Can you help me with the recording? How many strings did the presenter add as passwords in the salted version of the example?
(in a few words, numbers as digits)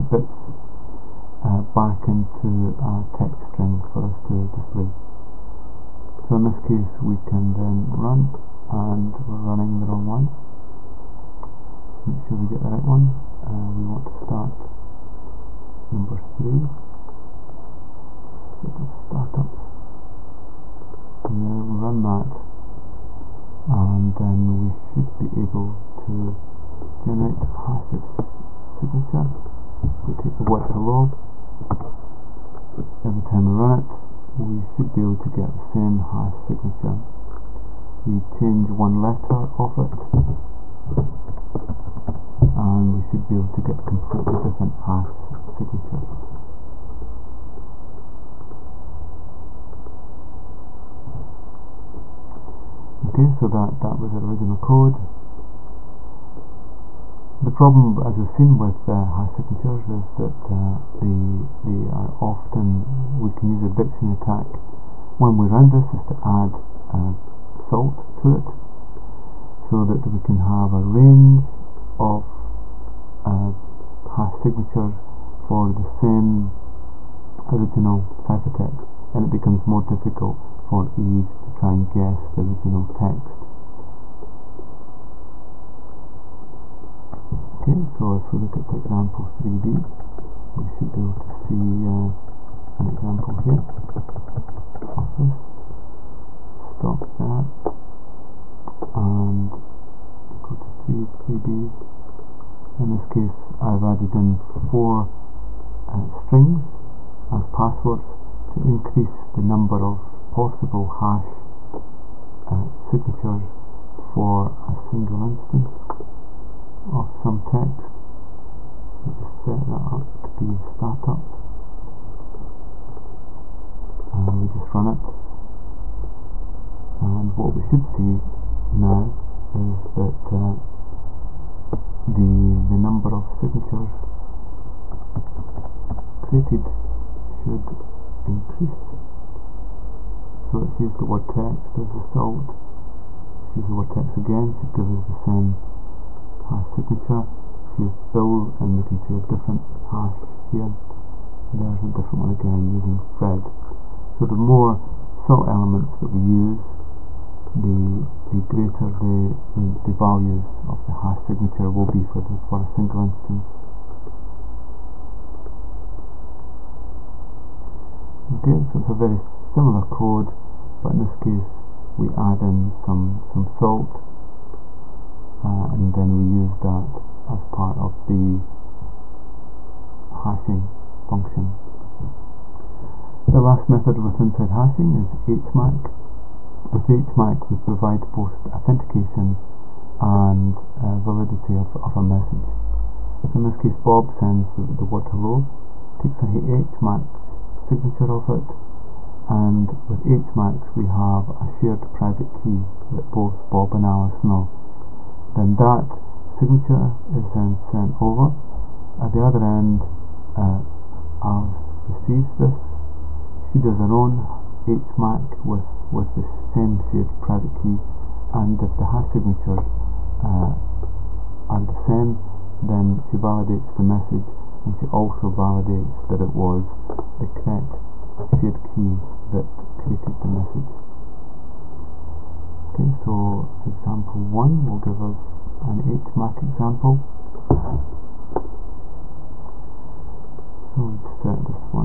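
4.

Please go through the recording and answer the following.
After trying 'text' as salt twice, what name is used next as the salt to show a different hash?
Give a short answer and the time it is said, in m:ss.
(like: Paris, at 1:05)
Bill, at 2:28.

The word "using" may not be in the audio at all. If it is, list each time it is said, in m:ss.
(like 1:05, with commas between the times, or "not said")
2:32.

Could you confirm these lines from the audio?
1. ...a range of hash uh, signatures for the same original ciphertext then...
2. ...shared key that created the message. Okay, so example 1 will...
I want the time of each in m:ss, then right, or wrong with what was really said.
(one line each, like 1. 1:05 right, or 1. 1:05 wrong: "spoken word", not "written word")
1. 1:10 right
2. 3:48 right.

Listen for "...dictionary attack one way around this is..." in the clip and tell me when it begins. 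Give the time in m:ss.
1:03.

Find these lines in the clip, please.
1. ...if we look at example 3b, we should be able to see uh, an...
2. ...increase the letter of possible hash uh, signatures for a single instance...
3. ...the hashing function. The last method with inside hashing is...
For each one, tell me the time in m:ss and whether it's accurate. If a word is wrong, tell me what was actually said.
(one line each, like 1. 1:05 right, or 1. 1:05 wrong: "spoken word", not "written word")
1. 1:28 right
2. 1:48 wrong: "number", not "letter"
3. 2:58 right.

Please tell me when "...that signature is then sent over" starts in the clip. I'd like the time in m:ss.
3:25.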